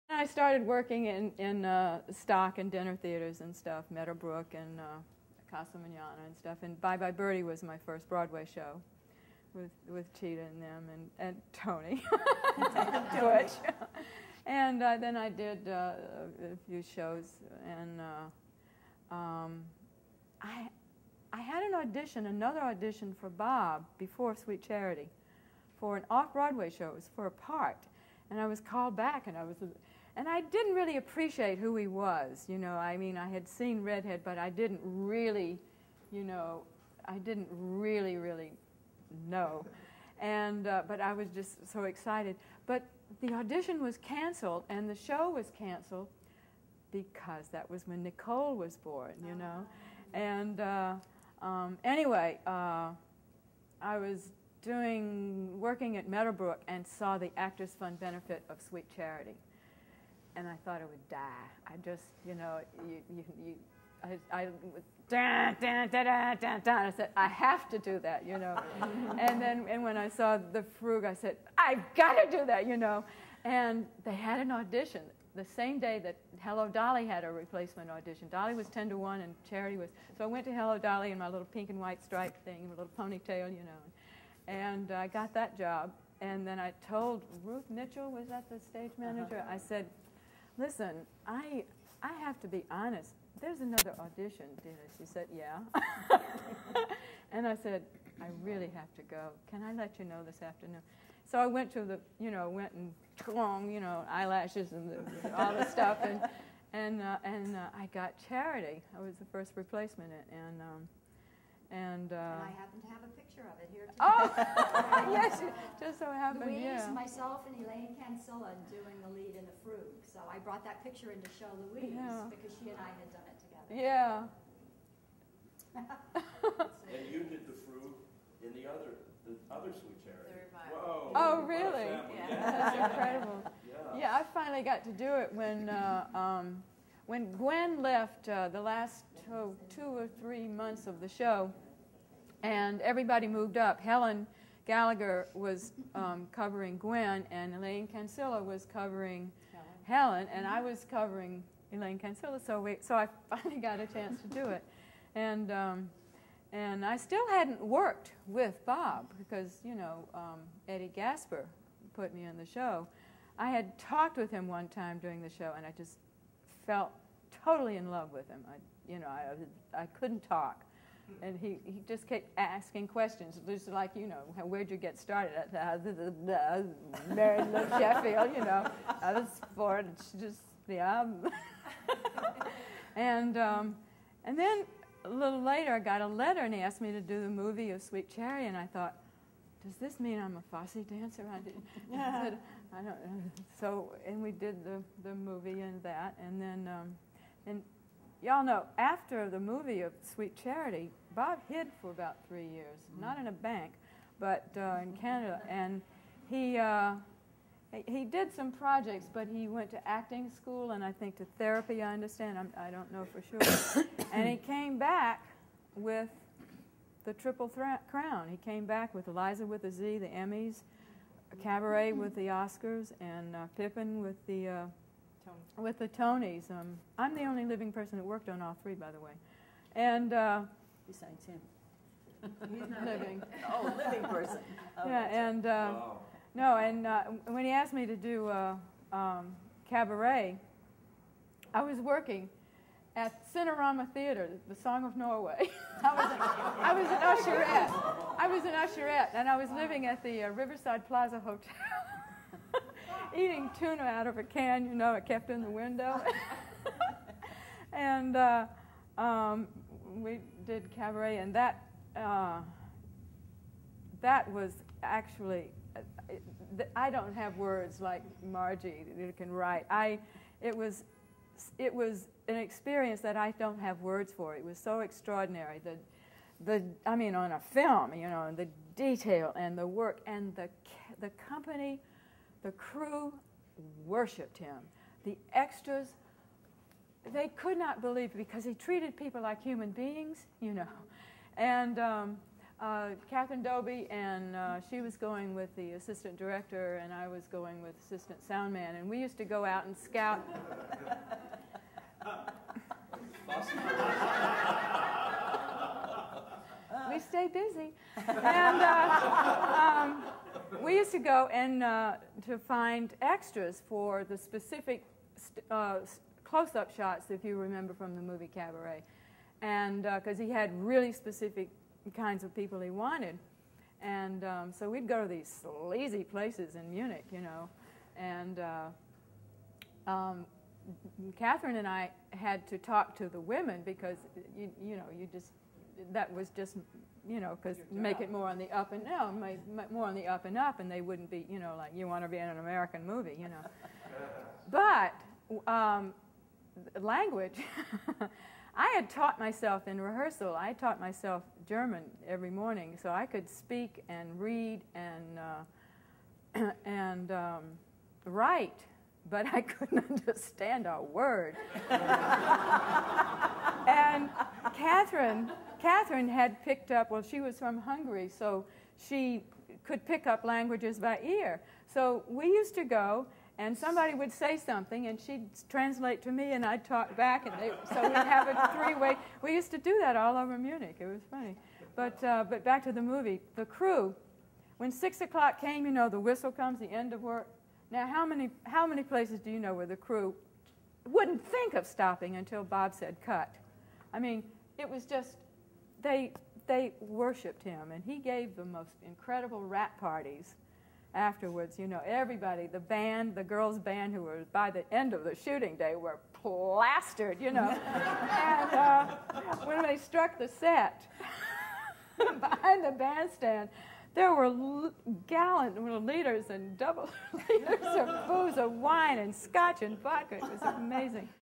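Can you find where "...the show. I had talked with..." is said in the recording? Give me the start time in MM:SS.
02:42.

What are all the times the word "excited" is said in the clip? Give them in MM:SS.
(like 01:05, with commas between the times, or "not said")
00:41.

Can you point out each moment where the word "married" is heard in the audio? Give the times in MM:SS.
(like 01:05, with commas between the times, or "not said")
02:57.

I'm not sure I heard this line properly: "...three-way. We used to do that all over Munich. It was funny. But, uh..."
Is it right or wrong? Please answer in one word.
right.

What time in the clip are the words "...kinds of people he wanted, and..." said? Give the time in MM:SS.
05:21.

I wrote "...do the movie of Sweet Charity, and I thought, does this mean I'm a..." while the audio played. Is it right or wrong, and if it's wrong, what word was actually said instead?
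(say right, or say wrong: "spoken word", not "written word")
right.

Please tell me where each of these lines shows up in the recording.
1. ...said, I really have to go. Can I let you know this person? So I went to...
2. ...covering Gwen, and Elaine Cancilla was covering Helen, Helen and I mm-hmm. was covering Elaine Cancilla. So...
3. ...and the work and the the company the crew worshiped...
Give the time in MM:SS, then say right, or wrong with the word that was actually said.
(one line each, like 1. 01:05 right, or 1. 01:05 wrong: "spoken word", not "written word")
1. 01:37 wrong: "afternoon", not "person"
2. 02:26 right
3. 04:39 right.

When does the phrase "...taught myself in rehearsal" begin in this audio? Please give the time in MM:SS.
05:48.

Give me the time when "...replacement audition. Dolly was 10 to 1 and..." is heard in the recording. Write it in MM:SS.
01:17.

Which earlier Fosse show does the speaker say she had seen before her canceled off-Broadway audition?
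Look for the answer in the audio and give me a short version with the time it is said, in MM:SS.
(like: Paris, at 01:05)
Redhead, at 00:33.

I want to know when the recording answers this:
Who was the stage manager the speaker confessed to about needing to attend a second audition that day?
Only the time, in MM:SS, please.
01:27.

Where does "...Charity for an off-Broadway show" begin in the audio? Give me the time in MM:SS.
00:24.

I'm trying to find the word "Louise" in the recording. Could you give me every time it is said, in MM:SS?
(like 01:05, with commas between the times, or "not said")
01:56, 02:01.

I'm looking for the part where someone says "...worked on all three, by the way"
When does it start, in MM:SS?
03:48.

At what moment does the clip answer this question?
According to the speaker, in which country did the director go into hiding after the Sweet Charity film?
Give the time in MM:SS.
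03:25.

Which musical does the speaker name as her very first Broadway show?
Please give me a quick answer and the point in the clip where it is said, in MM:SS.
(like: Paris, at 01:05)
Bye Bye Birdie, at 00:06.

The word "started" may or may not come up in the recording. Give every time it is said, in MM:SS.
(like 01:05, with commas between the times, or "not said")
00:00, 02:54.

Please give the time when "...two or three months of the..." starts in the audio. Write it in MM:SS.
02:19.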